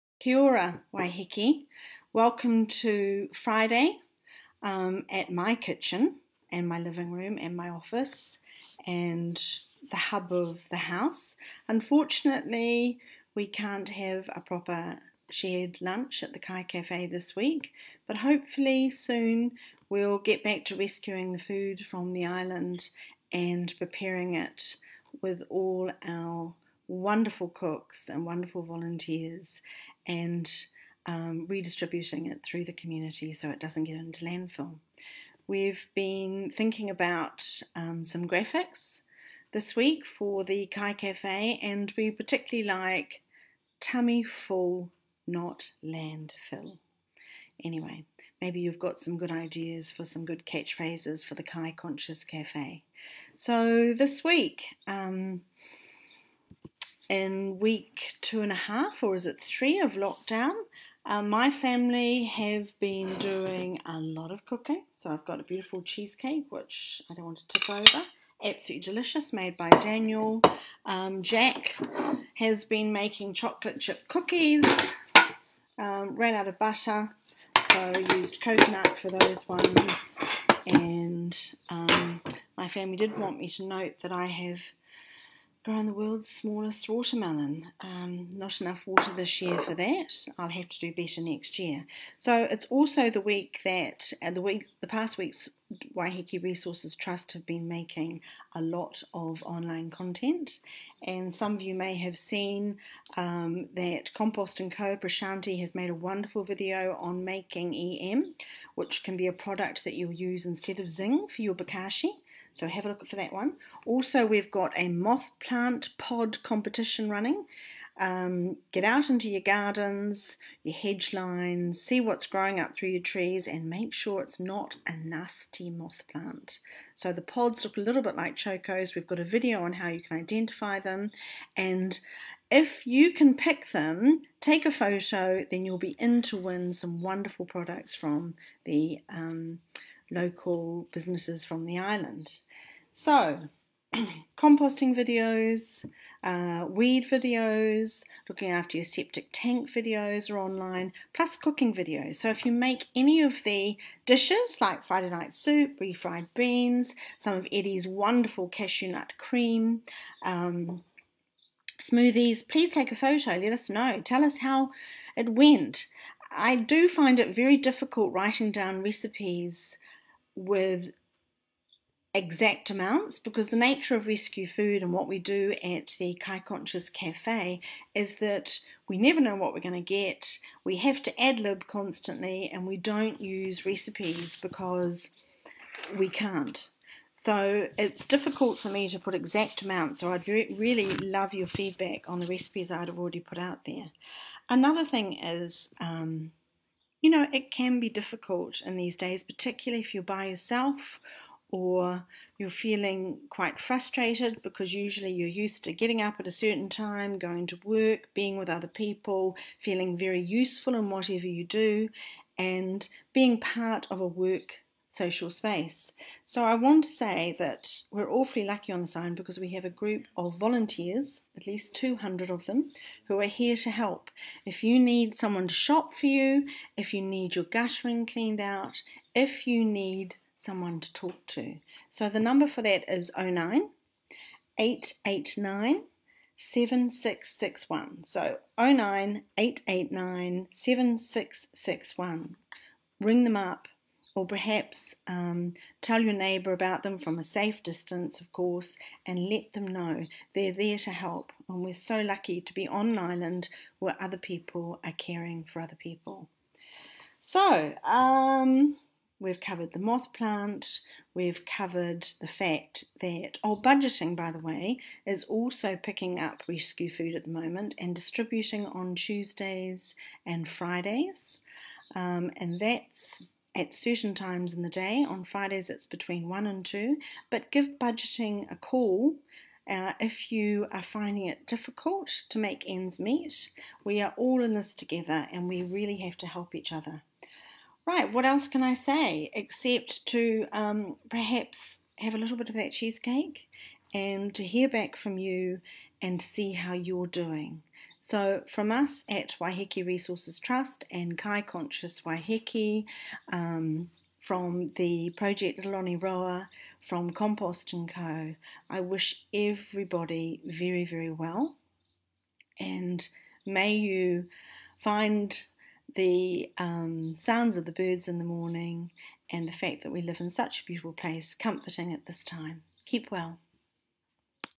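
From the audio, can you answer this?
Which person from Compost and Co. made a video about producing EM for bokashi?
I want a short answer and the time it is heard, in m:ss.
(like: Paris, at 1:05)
Prashanti, at 1:44.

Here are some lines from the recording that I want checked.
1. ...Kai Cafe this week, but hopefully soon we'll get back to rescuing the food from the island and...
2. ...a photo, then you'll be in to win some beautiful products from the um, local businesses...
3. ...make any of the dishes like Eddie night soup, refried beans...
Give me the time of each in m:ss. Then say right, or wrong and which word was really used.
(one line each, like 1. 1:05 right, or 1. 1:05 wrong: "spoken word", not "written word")
1. 0:16 right
2. 2:14 wrong: "wonderful", not "beautiful"
3. 2:32 wrong: "Friday", not "Eddie".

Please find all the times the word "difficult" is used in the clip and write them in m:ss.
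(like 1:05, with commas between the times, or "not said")
2:47, 3:08, 3:17, 4:41.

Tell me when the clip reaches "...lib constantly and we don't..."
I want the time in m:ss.
3:01.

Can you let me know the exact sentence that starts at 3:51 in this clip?
So the number for that is 09 889 7661.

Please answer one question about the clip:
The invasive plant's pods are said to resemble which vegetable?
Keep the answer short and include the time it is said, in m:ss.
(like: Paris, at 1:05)
chokos, at 2:08.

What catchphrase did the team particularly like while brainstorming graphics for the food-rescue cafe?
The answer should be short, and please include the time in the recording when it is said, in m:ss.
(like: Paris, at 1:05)
Tummy Full, Not Landfill, at 0:43.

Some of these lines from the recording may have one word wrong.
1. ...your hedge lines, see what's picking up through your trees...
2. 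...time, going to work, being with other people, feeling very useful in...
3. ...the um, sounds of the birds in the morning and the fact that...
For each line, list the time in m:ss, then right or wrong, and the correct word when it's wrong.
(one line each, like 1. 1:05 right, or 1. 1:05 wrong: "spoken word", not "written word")
1. 2:00 wrong: "growing", not "picking"
2. 3:26 right
3. 5:15 right.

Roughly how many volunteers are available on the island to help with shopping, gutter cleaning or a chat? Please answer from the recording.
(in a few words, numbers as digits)
200.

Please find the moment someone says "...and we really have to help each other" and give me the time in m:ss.
4:45.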